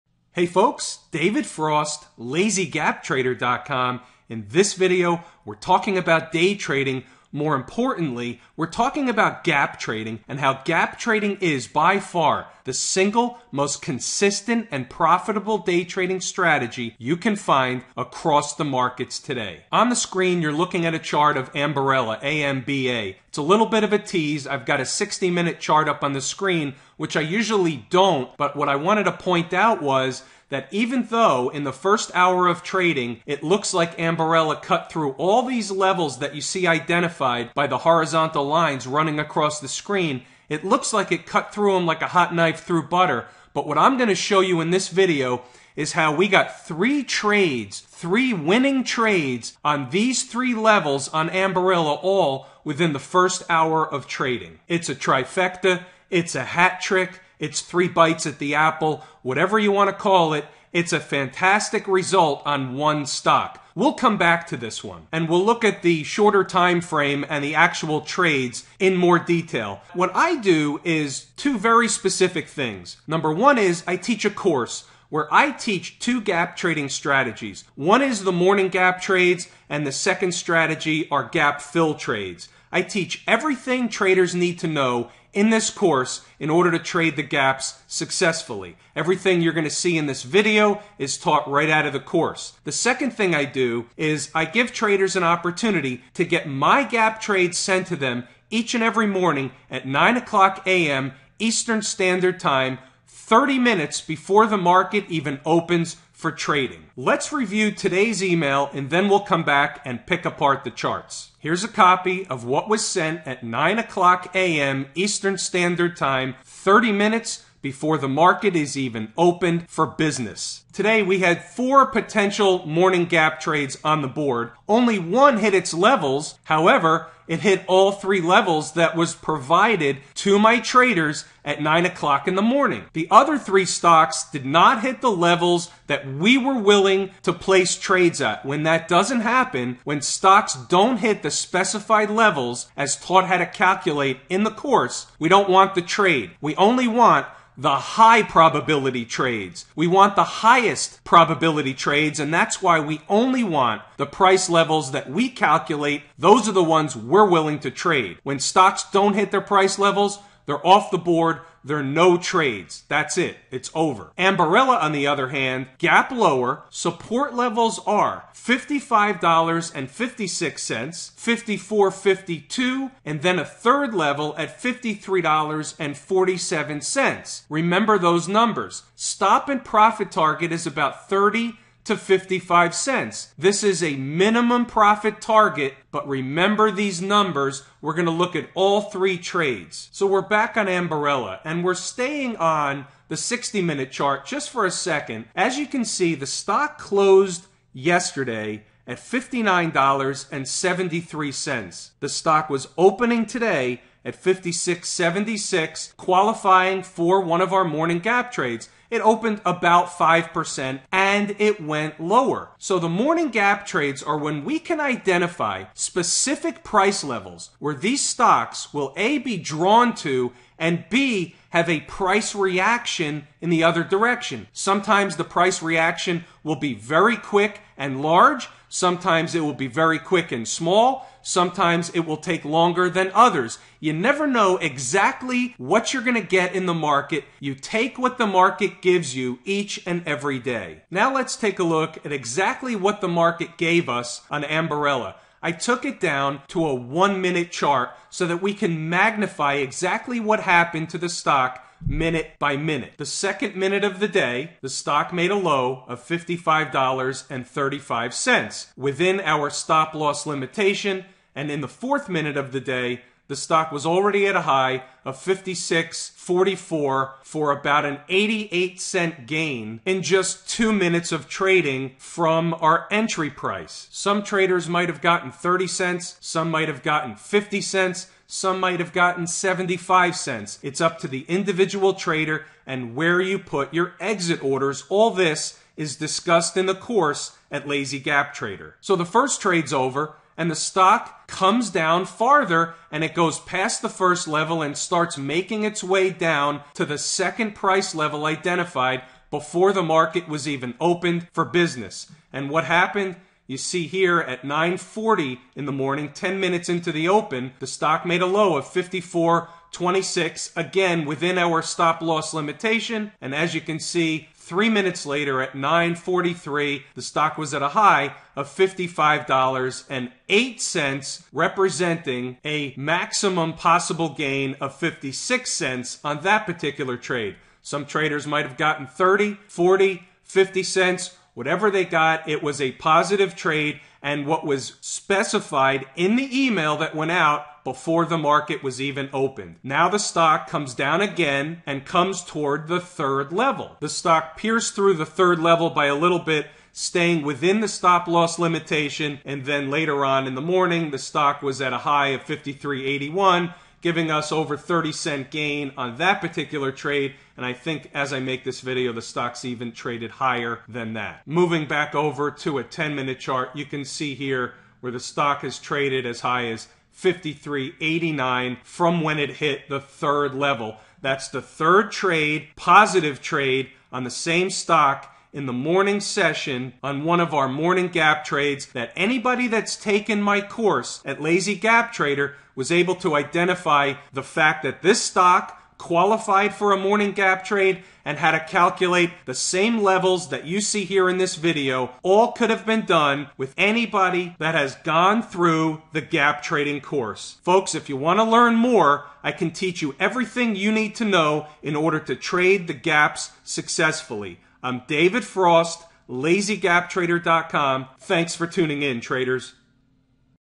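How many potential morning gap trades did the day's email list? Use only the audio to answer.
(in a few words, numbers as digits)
4.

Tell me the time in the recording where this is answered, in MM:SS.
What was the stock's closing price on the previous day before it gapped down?
03:18.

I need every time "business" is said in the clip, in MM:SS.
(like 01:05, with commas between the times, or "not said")
01:59, 05:01.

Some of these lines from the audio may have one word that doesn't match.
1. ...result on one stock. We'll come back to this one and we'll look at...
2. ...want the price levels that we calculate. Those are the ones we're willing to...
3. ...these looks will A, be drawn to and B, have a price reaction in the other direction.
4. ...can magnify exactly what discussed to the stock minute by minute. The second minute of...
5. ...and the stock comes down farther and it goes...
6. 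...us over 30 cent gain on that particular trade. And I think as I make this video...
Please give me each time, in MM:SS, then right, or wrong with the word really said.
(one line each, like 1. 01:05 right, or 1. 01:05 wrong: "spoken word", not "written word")
1. 01:01 right
2. 02:33 right
3. 03:37 wrong: "stocks", not "looks"
4. 04:08 wrong: "happened", not "discussed"
5. 04:50 right
6. 05:54 right.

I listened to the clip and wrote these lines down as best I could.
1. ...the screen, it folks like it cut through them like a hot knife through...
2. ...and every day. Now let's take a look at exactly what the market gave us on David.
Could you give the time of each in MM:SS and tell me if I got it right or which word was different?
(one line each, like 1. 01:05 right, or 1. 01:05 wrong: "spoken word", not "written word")
1. 00:39 wrong: "looks", not "folks"
2. 03:59 wrong: "Ambarella", not "David".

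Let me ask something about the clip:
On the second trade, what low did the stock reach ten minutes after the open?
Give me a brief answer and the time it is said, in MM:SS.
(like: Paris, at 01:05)
54.26, at 05:08.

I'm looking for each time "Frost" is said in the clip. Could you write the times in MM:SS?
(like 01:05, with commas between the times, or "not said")
00:01, 06:45.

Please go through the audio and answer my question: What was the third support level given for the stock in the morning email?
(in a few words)
$53.47.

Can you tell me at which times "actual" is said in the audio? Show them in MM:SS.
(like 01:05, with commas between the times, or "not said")
01:07.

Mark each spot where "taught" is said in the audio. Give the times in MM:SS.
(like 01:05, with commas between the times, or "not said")
01:31, 02:22.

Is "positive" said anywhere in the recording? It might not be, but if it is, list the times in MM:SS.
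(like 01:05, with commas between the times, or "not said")
05:32, 06:12.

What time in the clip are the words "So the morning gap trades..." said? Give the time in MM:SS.
03:32.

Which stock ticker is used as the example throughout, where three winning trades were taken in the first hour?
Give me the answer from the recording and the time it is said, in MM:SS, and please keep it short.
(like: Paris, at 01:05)
AMBA, at 00:22.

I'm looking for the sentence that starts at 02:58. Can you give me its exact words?
Stop and profit target is about 30 to 55 cents.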